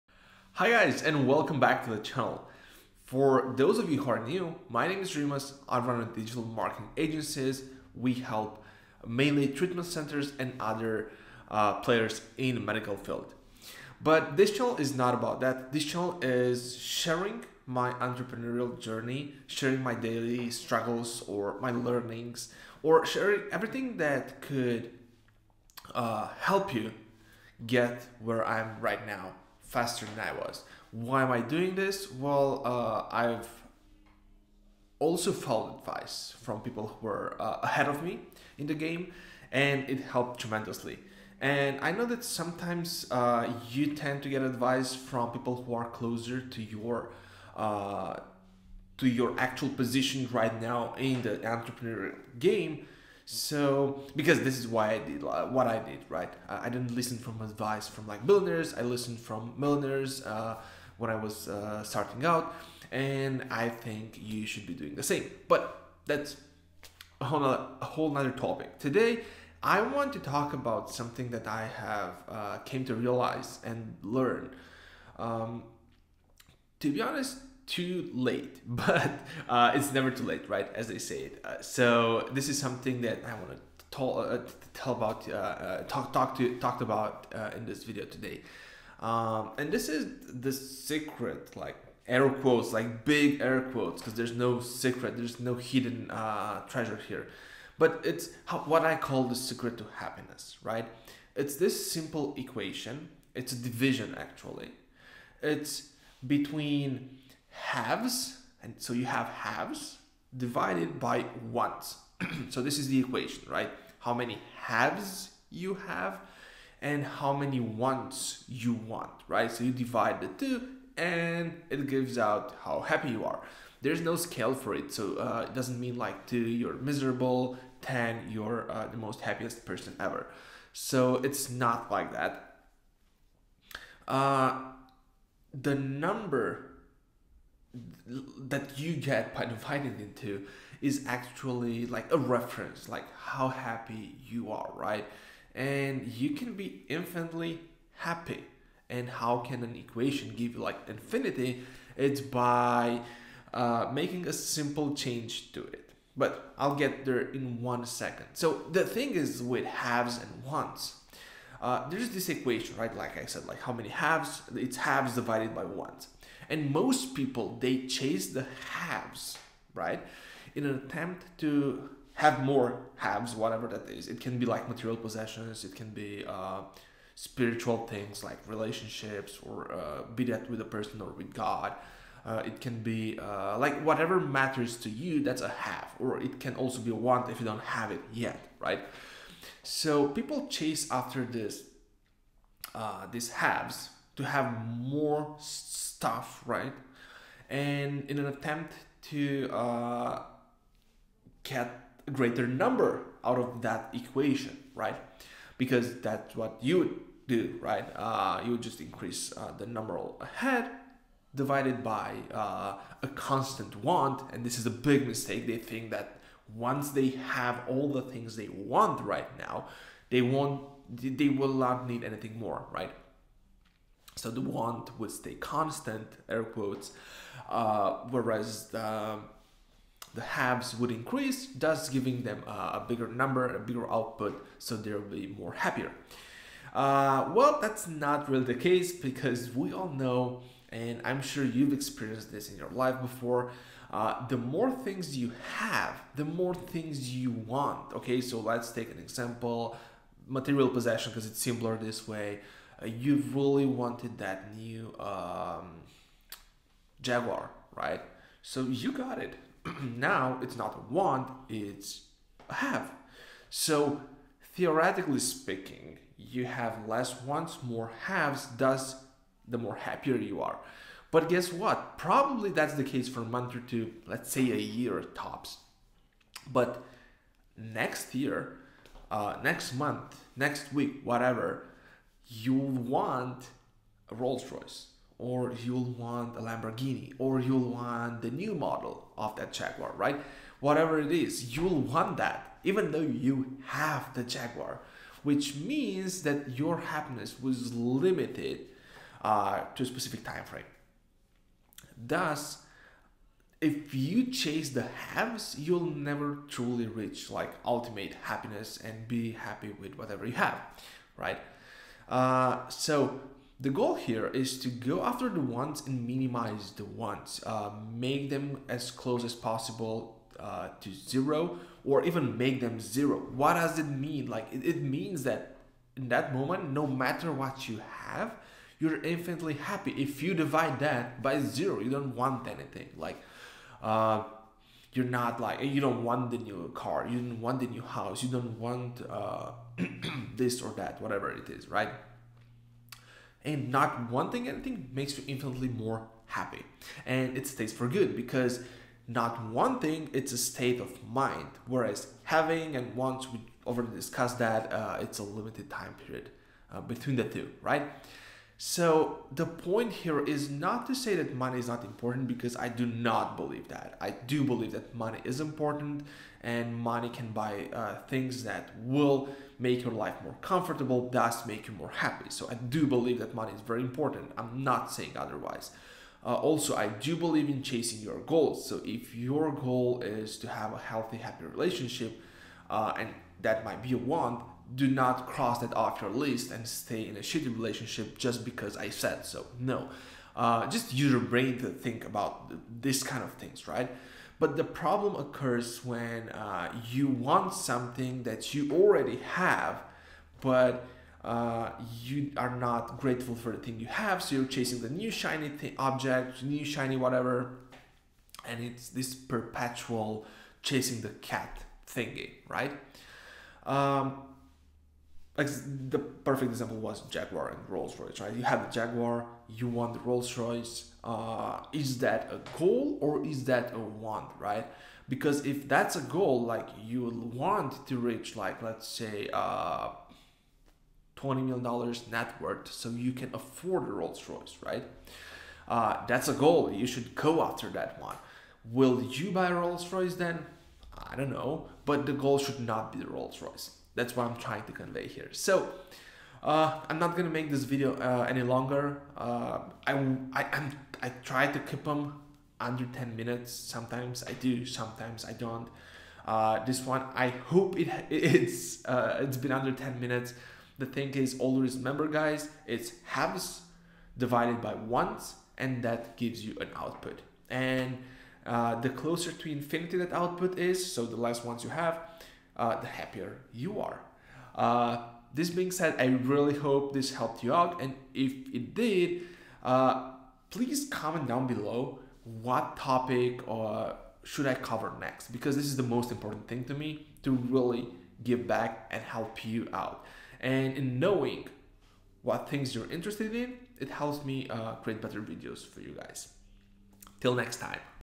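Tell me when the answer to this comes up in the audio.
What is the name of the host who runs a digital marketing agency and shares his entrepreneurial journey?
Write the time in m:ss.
0:05.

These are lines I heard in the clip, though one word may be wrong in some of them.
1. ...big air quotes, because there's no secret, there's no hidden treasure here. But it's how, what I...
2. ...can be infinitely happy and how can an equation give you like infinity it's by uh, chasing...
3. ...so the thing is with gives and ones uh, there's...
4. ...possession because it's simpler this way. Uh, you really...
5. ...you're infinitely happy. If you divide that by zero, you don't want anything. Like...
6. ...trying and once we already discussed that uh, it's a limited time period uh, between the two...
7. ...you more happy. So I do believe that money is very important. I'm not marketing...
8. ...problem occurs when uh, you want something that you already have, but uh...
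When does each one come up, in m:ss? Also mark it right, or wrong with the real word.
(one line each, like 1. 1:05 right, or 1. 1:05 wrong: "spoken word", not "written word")
1. 1:33 right
2. 2:26 wrong: "making", not "chasing"
3. 2:38 wrong: "haves", not "gives"
4. 4:10 right
5. 5:28 right
6. 5:52 wrong: "having", not "trying"
7. 6:11 wrong: "saying", not "marketing"
8. 6:34 right.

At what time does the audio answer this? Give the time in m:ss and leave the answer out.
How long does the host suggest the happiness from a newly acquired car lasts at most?
4:34.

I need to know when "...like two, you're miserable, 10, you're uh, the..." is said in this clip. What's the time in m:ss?
2:05.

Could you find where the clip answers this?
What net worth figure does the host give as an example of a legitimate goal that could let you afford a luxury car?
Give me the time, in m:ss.
7:11.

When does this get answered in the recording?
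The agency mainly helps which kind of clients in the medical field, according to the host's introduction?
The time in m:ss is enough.
0:09.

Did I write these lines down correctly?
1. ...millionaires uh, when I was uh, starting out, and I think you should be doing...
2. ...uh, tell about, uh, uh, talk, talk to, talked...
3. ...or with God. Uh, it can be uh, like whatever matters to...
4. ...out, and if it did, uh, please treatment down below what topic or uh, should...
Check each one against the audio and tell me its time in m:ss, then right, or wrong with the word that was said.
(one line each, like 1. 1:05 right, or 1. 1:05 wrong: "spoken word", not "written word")
1. 0:59 right
2. 1:24 right
3. 3:01 right
4. 7:57 wrong: "comment", not "treatment".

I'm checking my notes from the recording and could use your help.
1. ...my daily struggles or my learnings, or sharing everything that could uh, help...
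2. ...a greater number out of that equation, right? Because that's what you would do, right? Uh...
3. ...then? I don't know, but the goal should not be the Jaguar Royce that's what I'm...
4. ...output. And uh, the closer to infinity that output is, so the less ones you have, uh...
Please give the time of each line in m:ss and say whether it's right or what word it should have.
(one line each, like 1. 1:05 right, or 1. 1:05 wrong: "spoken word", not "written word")
1. 0:19 right
2. 3:22 right
3. 7:20 wrong: "Rolls", not "Jaguar"
4. 7:46 right.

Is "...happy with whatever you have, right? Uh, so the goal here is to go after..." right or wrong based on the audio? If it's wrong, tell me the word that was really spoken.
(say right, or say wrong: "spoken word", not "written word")
right.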